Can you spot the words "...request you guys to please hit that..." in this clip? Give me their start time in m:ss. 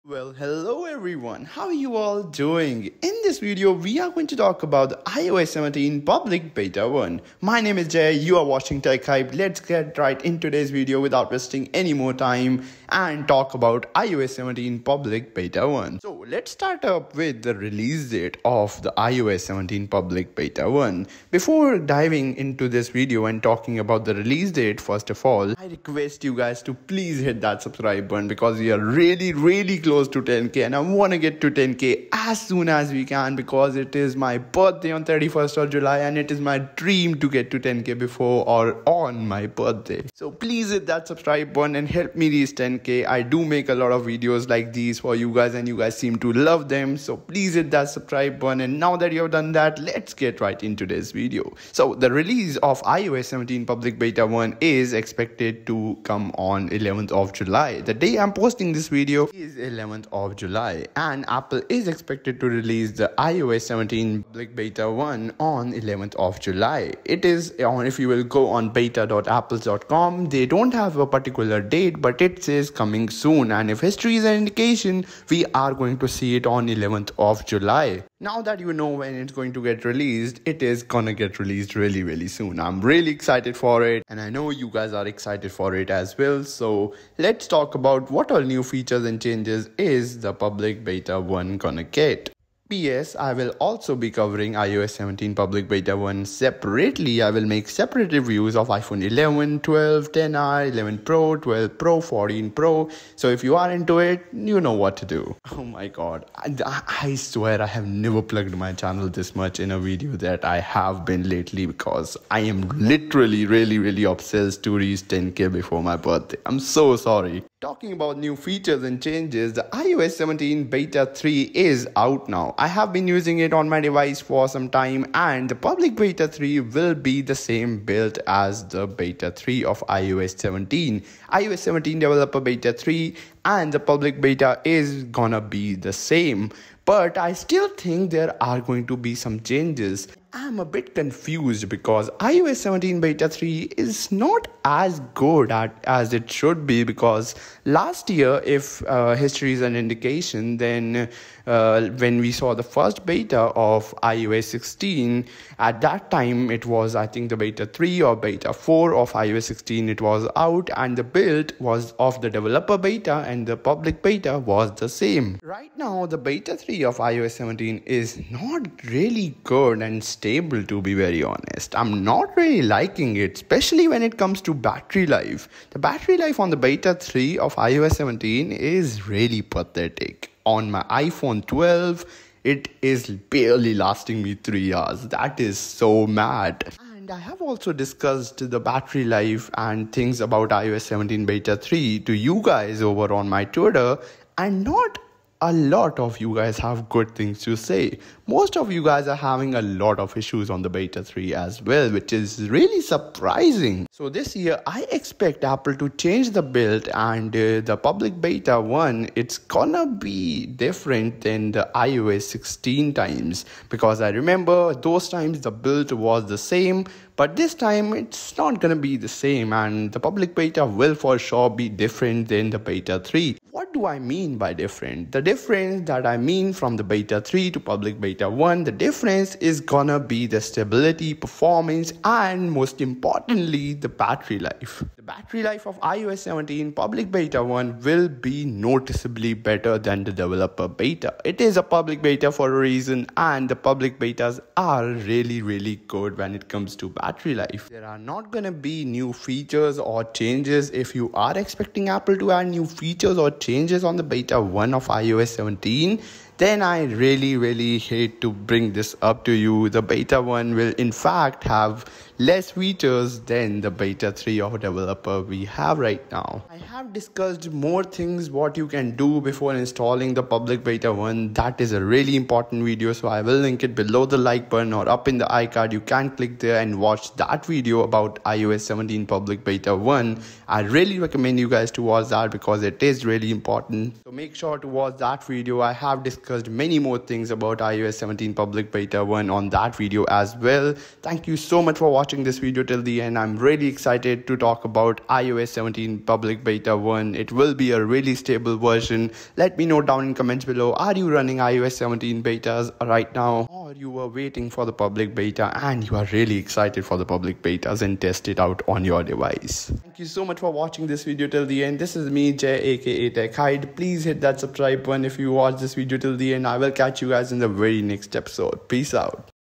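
0:25.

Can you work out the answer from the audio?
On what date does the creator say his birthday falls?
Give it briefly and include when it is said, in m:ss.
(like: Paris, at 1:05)
31st of July, at 0:35.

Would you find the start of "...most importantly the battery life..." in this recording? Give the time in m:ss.
3:52.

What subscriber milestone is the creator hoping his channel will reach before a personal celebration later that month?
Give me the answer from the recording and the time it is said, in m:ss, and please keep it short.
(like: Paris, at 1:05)
10k, at 0:31.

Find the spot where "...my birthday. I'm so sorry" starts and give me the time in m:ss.
1:55.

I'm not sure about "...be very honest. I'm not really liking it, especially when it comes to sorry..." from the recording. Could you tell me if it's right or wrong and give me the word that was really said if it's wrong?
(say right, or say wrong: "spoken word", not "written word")
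wrong: "battery", not "sorry".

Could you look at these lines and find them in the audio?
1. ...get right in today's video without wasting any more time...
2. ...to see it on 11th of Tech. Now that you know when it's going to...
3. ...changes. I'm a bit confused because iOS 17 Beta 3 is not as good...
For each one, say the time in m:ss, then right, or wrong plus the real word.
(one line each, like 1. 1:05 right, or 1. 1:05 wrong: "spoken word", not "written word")
1. 0:09 right
2. 1:15 wrong: "July", not "Tech"
3. 2:19 right.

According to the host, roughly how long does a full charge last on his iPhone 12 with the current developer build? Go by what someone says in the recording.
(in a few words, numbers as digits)
3 hours.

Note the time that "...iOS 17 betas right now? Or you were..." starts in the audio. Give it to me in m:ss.
5:01.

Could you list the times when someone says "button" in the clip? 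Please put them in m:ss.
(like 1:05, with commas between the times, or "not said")
0:28, 0:41, 0:48, 4:34, 5:14.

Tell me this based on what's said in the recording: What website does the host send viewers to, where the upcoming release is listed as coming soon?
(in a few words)
beta.apples.com.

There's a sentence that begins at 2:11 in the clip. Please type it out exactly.
iOS 17 Developer Beta 3 and the public Beta is gonna be the same.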